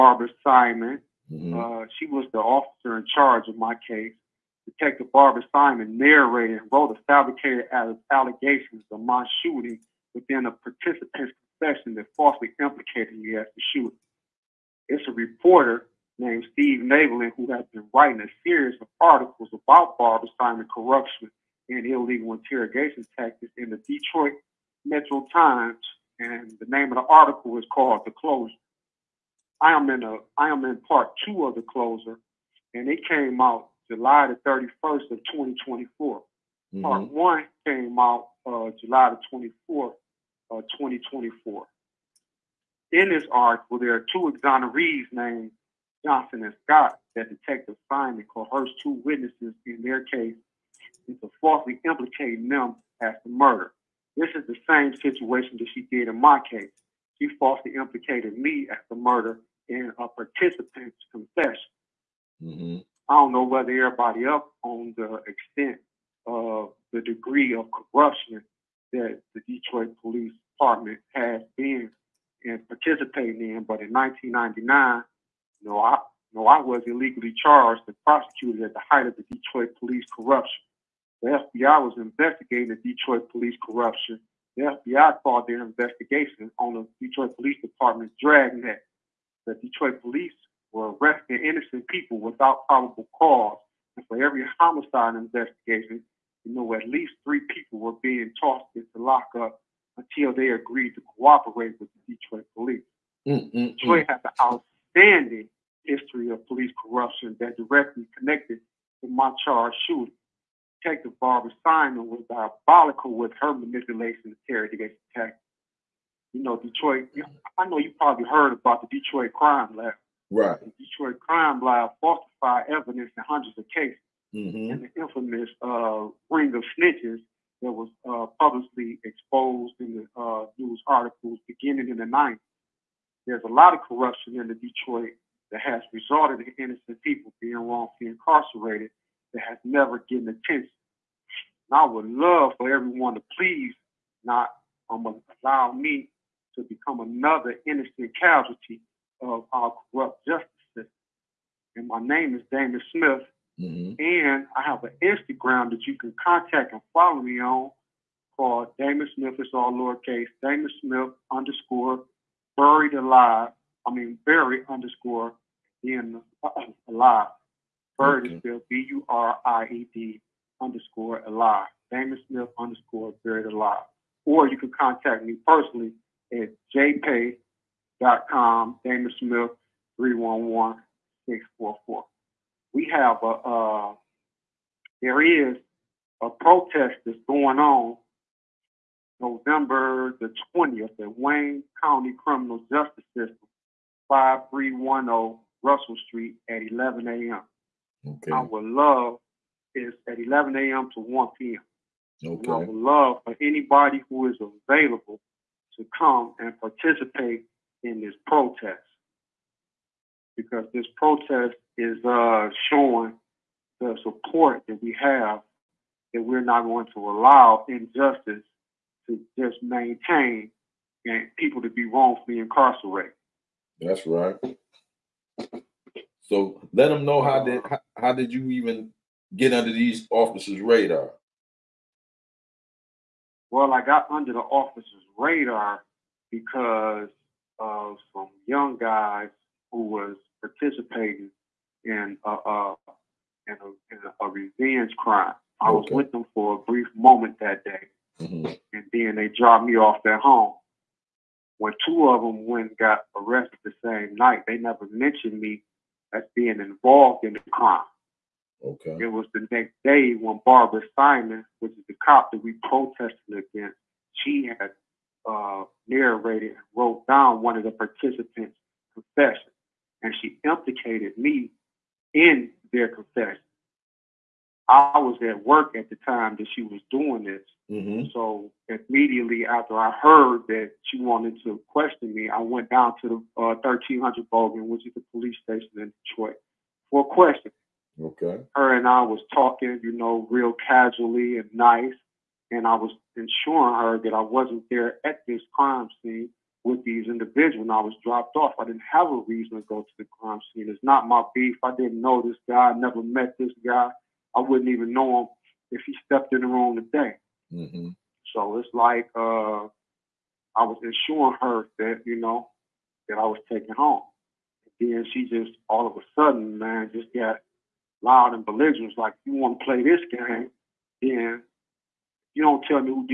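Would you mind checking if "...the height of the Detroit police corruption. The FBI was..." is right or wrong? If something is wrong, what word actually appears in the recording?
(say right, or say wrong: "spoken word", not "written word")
right.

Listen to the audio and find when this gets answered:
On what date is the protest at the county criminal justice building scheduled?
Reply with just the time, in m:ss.
3:09.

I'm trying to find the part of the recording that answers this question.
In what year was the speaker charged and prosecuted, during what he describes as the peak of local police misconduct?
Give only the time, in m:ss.
1:13.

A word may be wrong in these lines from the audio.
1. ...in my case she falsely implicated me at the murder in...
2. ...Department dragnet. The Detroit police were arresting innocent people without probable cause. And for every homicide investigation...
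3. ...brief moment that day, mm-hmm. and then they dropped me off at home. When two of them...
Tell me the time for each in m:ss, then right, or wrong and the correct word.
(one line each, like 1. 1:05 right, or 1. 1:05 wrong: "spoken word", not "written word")
1. 0:56 right
2. 1:27 right
3. 4:06 right.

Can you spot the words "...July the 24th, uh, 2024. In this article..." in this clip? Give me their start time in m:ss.
0:38.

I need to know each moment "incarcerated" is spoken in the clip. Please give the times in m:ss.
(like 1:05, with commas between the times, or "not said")
2:18, 3:42.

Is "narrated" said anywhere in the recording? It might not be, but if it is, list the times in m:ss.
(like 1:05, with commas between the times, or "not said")
0:05, 4:25.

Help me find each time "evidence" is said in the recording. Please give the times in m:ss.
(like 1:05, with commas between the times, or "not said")
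2:02.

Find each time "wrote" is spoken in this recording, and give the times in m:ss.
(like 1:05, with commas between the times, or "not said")
0:06, 4:26.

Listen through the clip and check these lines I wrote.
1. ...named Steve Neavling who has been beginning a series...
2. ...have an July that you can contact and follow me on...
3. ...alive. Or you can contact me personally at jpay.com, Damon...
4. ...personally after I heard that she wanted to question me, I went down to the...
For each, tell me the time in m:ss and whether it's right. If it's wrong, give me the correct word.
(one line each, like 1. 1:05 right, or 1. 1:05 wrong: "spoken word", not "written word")
1. 0:16 wrong: "writing", not "beginning"
2. 2:34 wrong: "Instagram", not "July"
3. 2:53 right
4. 4:38 wrong: "immediately", not "personally".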